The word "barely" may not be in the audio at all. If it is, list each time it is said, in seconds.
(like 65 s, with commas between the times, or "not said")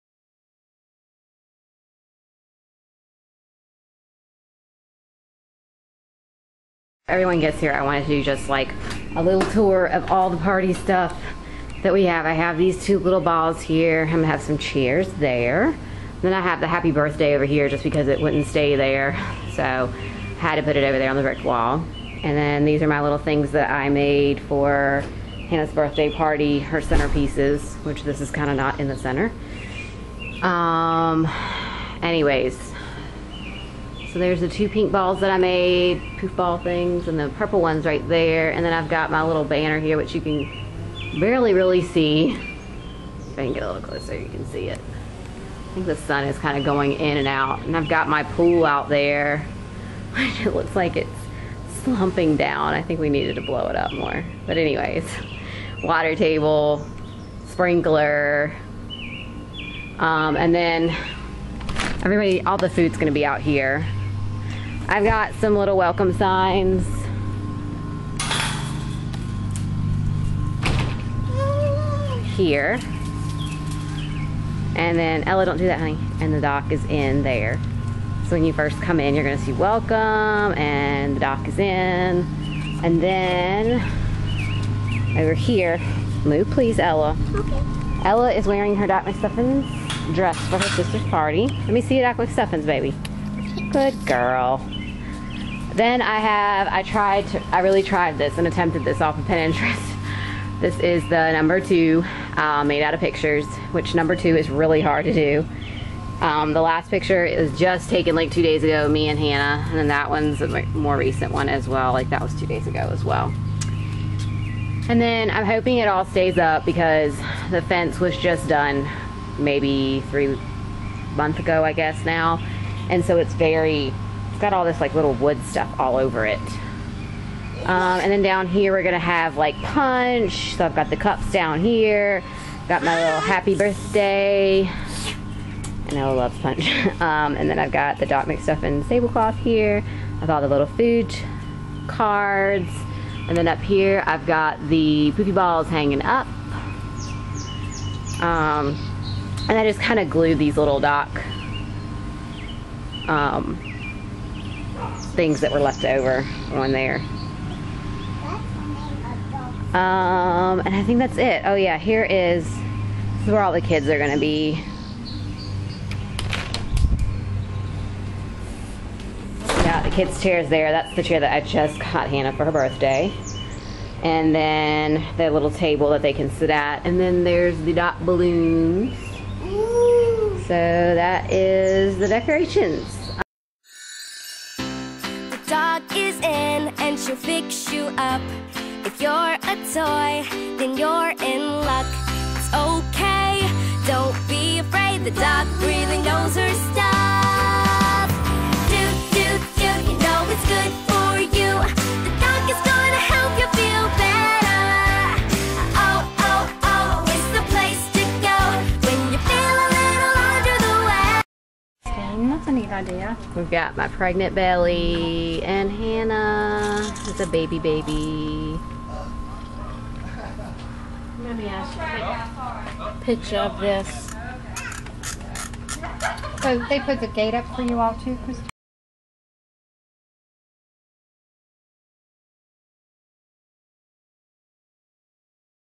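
41 s.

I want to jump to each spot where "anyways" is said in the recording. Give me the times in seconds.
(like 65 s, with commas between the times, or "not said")
32 s, 54 s.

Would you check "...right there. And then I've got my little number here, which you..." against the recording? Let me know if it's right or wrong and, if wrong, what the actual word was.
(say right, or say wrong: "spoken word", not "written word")
wrong: "banner", not "number".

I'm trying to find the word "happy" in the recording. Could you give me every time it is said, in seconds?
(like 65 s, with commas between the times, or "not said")
16 s, 133 s.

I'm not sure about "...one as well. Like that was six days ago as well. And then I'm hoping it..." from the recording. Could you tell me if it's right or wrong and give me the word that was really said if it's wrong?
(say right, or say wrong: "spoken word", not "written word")
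wrong: "two", not "six".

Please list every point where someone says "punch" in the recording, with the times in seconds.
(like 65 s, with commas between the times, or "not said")
129 s, 136 s.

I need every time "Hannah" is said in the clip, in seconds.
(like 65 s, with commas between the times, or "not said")
25 s, 109 s, 172 s, 215 s.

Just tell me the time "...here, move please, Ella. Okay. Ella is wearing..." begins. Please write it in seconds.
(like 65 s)
85 s.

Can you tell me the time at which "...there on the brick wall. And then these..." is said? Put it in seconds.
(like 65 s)
20 s.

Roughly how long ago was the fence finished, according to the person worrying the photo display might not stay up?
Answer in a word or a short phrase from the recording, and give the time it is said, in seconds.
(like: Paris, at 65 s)
3 months, at 120 s.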